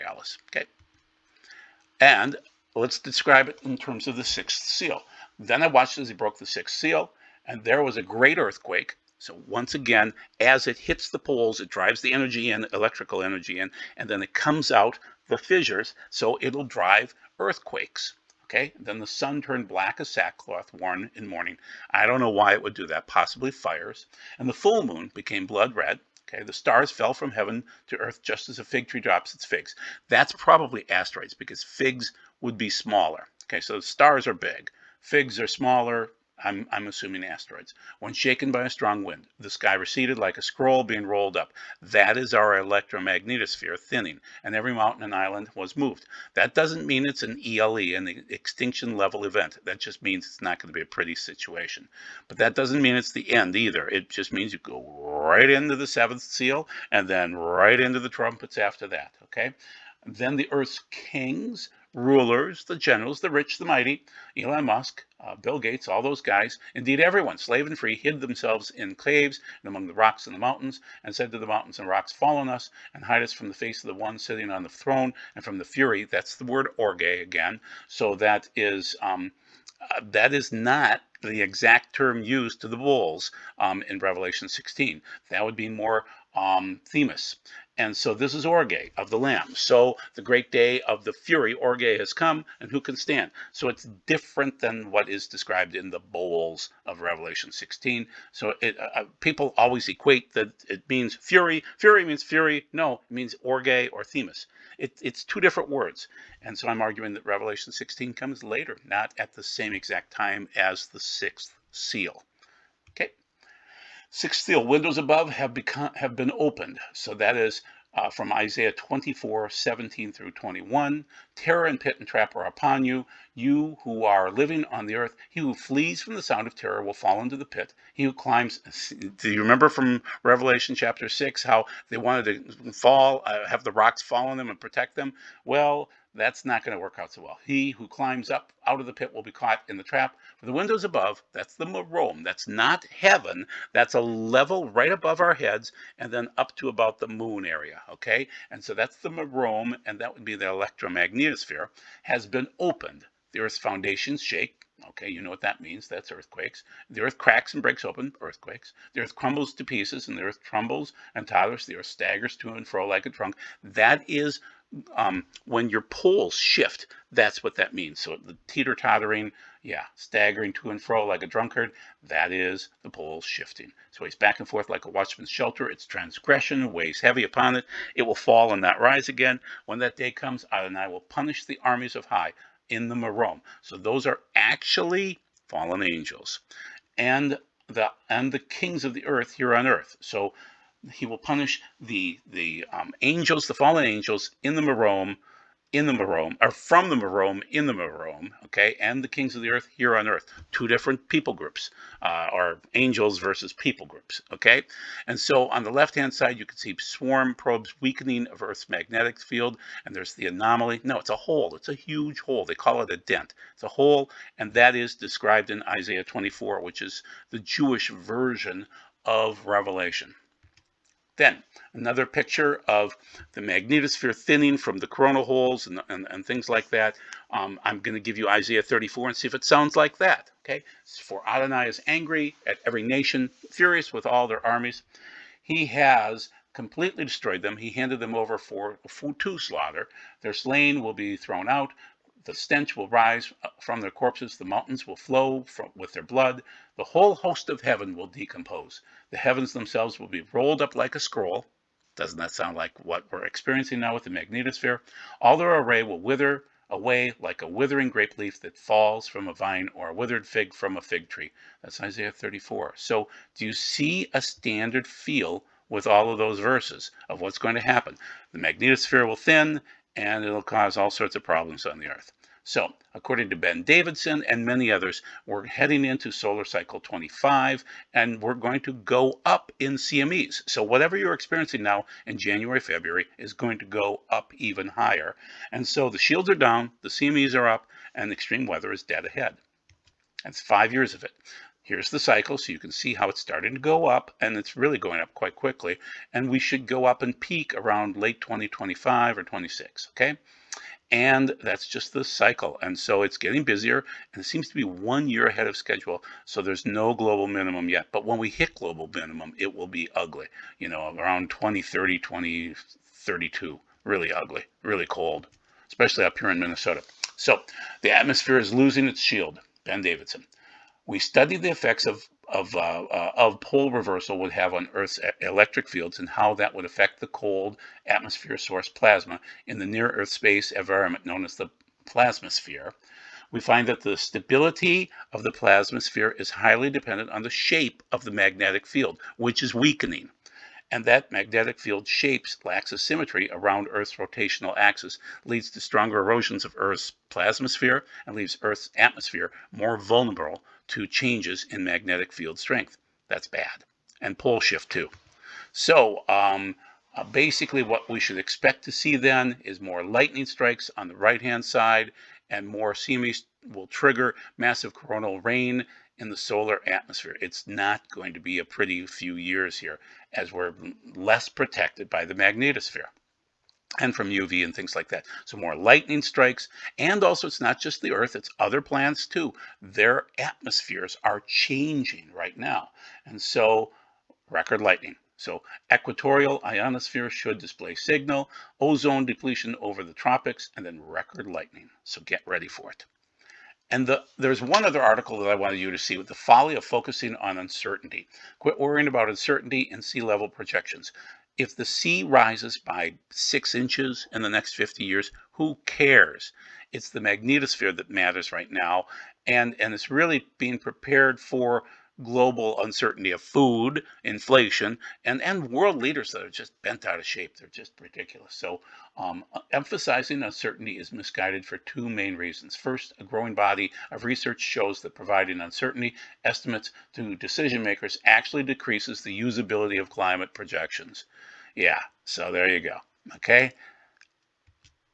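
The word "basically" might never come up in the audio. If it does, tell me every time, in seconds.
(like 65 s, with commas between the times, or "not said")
357 s.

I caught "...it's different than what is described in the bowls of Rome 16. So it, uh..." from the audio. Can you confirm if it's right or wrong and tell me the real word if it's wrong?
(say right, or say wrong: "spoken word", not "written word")
wrong: "Revelation", not "Rome".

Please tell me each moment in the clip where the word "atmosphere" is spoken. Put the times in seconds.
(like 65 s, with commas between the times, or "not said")
317 s, 327 s, 348 s, 366 s, 380 s.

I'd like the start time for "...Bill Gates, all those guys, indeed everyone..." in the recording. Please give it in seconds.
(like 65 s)
65 s.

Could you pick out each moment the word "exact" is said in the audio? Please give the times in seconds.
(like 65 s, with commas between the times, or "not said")
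81 s, 109 s.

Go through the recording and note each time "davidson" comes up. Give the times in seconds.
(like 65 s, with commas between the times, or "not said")
273 s, 319 s.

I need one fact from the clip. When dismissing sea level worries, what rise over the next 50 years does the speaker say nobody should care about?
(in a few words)
6 inches.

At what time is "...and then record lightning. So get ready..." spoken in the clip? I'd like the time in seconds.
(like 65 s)
390 s.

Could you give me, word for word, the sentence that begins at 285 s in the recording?
And so, the shields are down, the CMEs are up, and extreme weather is dead ahead.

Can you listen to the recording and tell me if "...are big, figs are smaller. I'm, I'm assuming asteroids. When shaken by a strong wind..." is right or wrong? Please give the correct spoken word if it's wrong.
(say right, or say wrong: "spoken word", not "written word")
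right.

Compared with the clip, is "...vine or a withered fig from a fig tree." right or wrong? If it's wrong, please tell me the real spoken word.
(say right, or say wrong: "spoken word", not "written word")
right.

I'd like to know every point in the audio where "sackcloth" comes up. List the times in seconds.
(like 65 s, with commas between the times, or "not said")
20 s.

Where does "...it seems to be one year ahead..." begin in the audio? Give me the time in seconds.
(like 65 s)
304 s.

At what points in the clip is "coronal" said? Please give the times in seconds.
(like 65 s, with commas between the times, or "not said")
224 s, 364 s.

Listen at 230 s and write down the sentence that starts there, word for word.
Okay, for Adonai is angry at every nation, furious with all their armies.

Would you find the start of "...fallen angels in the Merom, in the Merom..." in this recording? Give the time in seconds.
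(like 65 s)
193 s.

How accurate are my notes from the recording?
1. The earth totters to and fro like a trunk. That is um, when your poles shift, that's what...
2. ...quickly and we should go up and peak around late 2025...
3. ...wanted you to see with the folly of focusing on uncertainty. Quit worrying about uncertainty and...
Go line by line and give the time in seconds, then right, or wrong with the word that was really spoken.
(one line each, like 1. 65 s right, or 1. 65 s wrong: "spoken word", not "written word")
1. 161 s wrong: "staggers", not "totters"
2. 295 s right
3. 395 s right.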